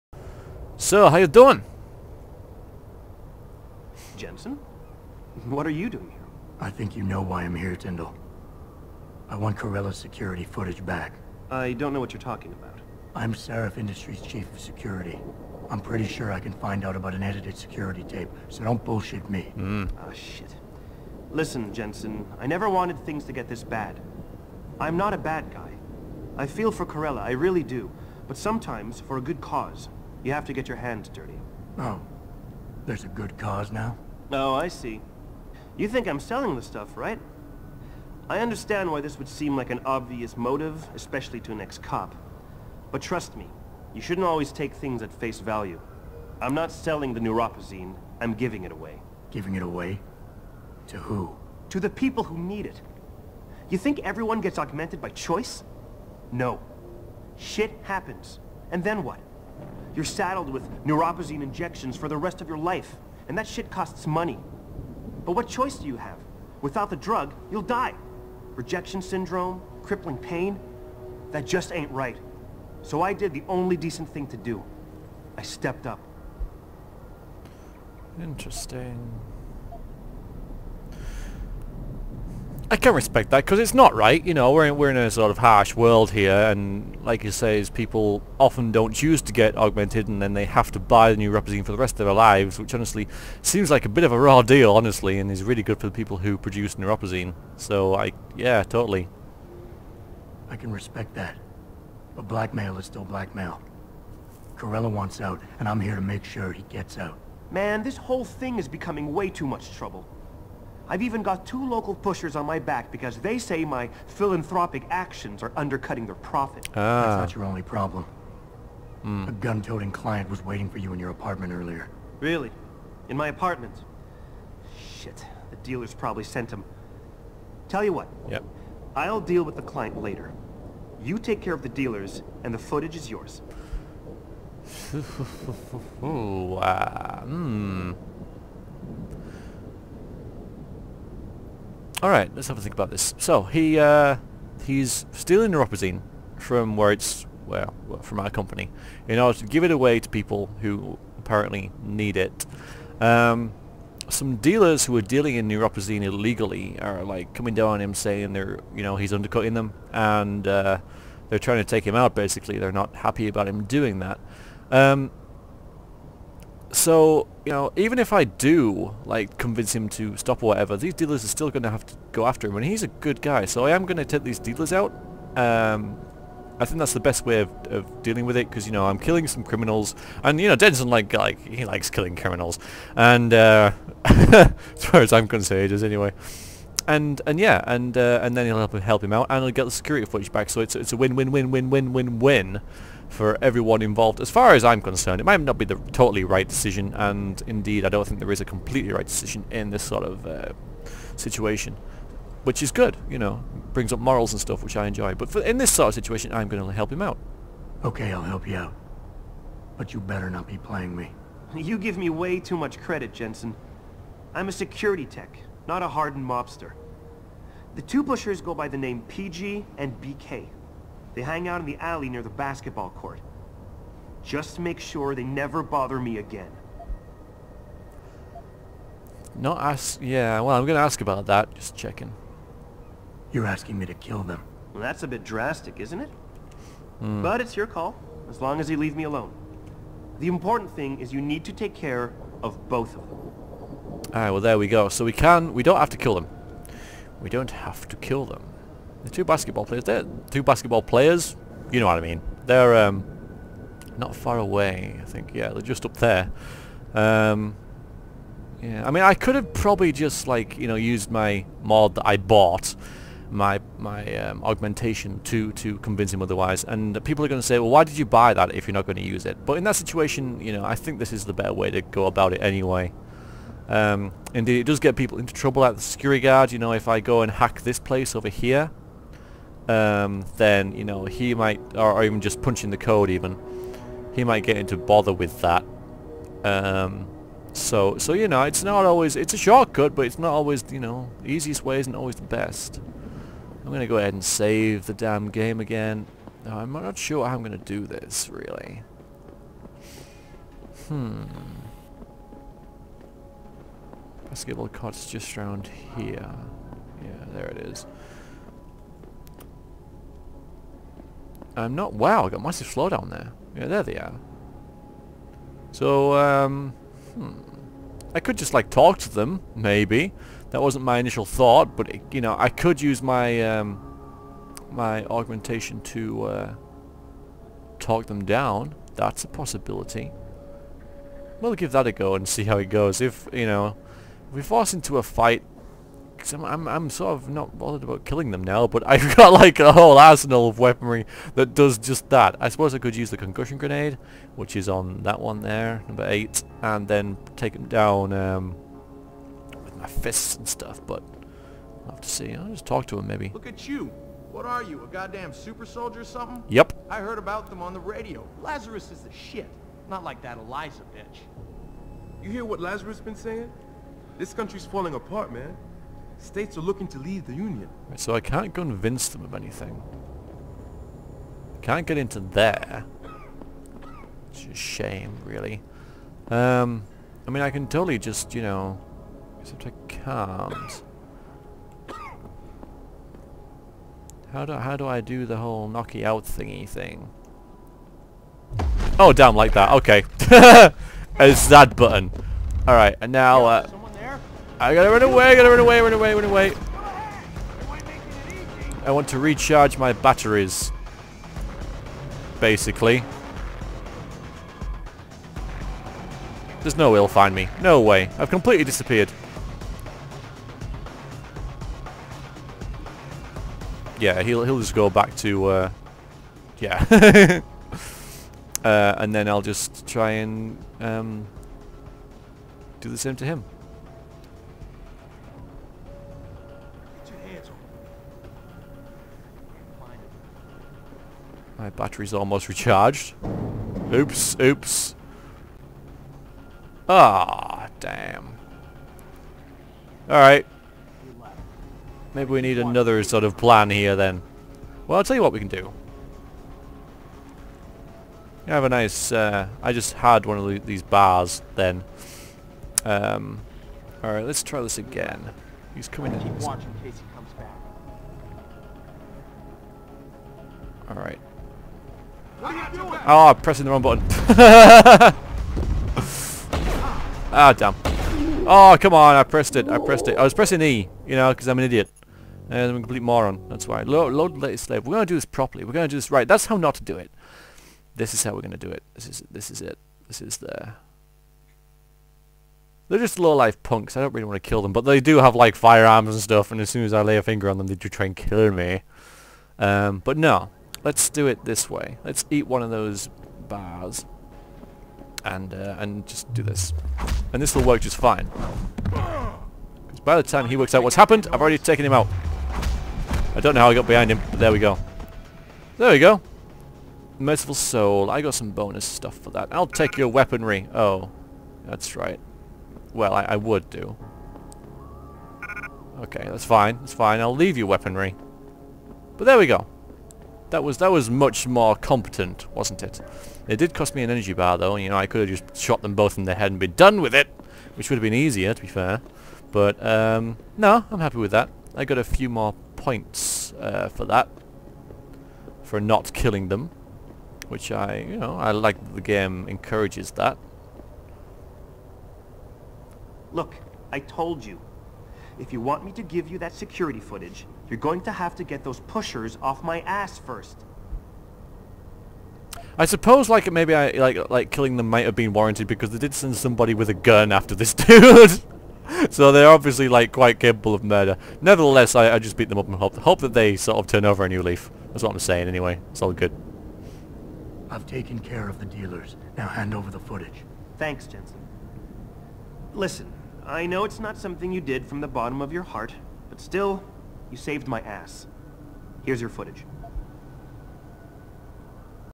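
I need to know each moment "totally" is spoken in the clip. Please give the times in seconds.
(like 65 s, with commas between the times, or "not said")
98 s, 195 s, 377 s.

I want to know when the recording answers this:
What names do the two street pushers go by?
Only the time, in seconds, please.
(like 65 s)
219 s.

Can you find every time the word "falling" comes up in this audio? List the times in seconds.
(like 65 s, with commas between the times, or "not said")
364 s.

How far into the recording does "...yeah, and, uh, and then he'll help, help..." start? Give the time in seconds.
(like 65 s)
187 s.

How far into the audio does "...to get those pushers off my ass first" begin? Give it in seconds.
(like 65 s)
548 s.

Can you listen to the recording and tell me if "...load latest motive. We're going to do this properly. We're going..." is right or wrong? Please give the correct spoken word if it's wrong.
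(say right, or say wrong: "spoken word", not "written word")
wrong: "slave", not "motive".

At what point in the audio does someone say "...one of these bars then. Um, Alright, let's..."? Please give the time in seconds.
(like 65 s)
450 s.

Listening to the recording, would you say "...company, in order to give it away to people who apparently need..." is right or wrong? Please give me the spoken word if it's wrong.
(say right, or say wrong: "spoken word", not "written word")
right.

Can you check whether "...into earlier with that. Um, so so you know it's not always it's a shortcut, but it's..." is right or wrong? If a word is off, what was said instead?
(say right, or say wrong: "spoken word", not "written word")
wrong: "bother", not "earlier".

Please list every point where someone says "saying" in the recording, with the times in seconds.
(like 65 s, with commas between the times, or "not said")
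157 s, 363 s, 565 s.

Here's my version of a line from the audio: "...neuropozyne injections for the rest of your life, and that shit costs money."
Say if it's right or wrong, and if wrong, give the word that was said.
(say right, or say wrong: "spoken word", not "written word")
right.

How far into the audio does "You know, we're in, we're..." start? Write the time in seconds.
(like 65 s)
84 s.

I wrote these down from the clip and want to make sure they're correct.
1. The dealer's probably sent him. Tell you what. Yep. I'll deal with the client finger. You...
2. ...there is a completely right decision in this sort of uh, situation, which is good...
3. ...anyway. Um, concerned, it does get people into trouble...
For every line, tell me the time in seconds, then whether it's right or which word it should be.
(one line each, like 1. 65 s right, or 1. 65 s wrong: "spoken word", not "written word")
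1. 125 s wrong: "later", not "finger"
2. 198 s right
3. 272 s wrong: "indeed", not "concerned".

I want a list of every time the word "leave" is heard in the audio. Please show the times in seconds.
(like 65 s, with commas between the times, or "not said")
238 s, 366 s, 517 s.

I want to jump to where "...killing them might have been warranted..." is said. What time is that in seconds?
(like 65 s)
554 s.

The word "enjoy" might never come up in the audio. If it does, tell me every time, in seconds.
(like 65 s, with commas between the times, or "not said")
204 s.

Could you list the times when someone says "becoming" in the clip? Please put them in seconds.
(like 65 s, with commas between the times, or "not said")
108 s.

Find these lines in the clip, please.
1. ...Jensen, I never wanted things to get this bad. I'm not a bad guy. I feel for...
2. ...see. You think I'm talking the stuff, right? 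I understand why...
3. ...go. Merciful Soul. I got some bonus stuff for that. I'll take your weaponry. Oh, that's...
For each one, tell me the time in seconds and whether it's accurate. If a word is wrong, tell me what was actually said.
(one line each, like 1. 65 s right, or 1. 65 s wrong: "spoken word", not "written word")
1. 21 s right
2. 34 s wrong: "selling", not "talking"
3. 505 s right.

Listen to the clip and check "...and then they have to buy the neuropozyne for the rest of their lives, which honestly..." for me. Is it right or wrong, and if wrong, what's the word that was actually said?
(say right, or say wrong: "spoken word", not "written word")
right.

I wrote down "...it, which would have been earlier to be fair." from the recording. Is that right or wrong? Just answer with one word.
wrong.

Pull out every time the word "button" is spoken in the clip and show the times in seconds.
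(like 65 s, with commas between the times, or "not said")
391 s, 463 s.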